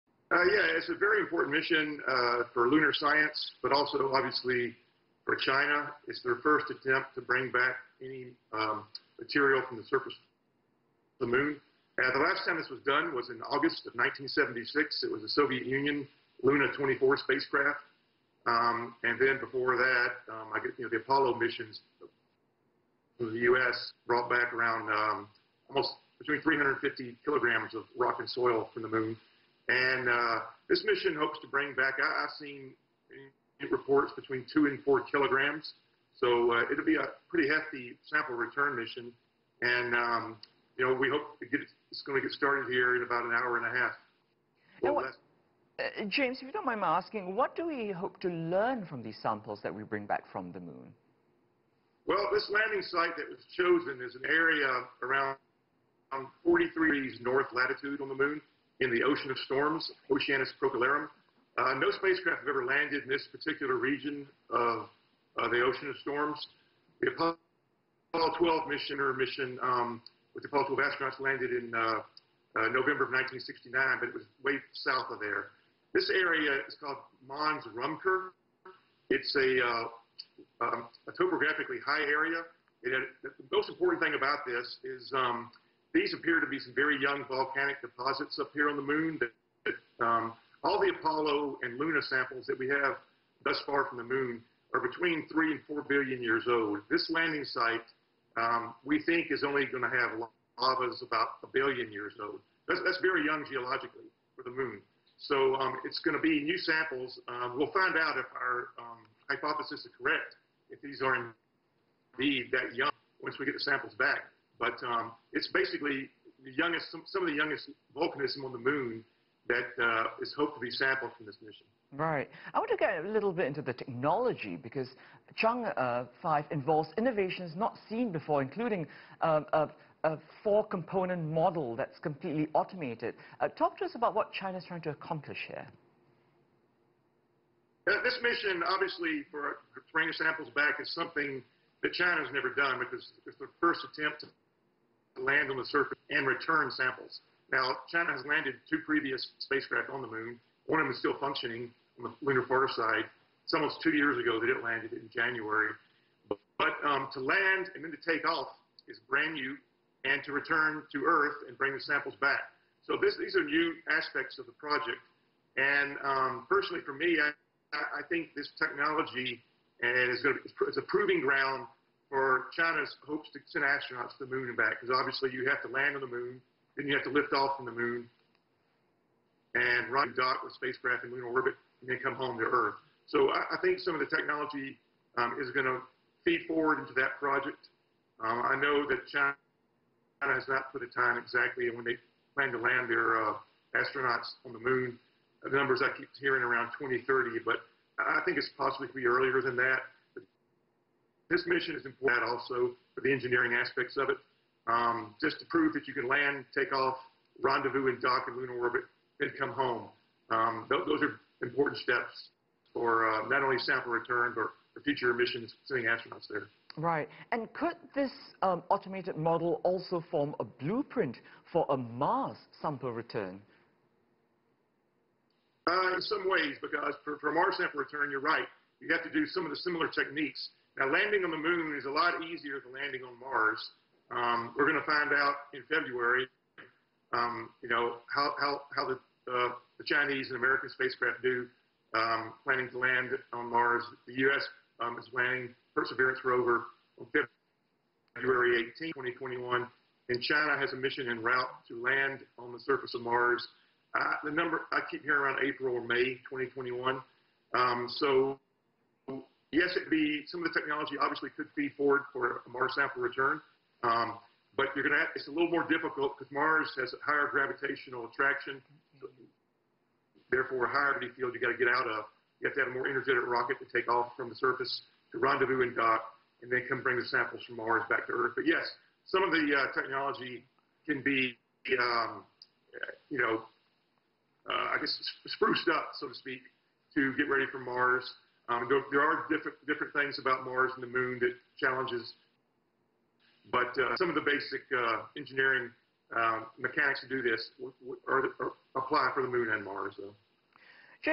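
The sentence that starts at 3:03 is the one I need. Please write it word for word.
So I, I think some of the technology um, is going to feed forward into that project.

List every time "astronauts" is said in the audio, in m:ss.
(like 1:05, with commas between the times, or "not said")
1:10, 2:53, 3:13, 3:35.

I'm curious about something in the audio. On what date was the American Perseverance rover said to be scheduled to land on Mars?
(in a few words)
February 18, 2021.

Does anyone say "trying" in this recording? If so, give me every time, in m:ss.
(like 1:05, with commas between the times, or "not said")
2:14.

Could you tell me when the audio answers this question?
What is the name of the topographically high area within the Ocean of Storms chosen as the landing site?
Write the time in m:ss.
1:17.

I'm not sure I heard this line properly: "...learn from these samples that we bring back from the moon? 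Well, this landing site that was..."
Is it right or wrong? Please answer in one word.
right.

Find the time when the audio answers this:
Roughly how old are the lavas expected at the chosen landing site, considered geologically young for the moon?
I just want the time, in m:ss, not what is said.
1:41.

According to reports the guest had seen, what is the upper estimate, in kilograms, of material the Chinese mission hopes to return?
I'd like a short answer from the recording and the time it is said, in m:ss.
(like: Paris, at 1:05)
4 kilograms, at 0:34.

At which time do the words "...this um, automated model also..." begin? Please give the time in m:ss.
3:37.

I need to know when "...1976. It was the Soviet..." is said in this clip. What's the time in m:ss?
0:13.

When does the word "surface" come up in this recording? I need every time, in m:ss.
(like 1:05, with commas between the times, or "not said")
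0:09, 2:25, 4:12, 4:34.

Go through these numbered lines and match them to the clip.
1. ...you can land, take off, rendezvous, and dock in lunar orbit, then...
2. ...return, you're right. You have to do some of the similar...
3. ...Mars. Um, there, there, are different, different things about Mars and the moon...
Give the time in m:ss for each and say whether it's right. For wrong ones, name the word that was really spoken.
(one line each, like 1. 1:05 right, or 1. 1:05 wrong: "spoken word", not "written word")
1. 3:25 right
2. 3:47 right
3. 4:47 right.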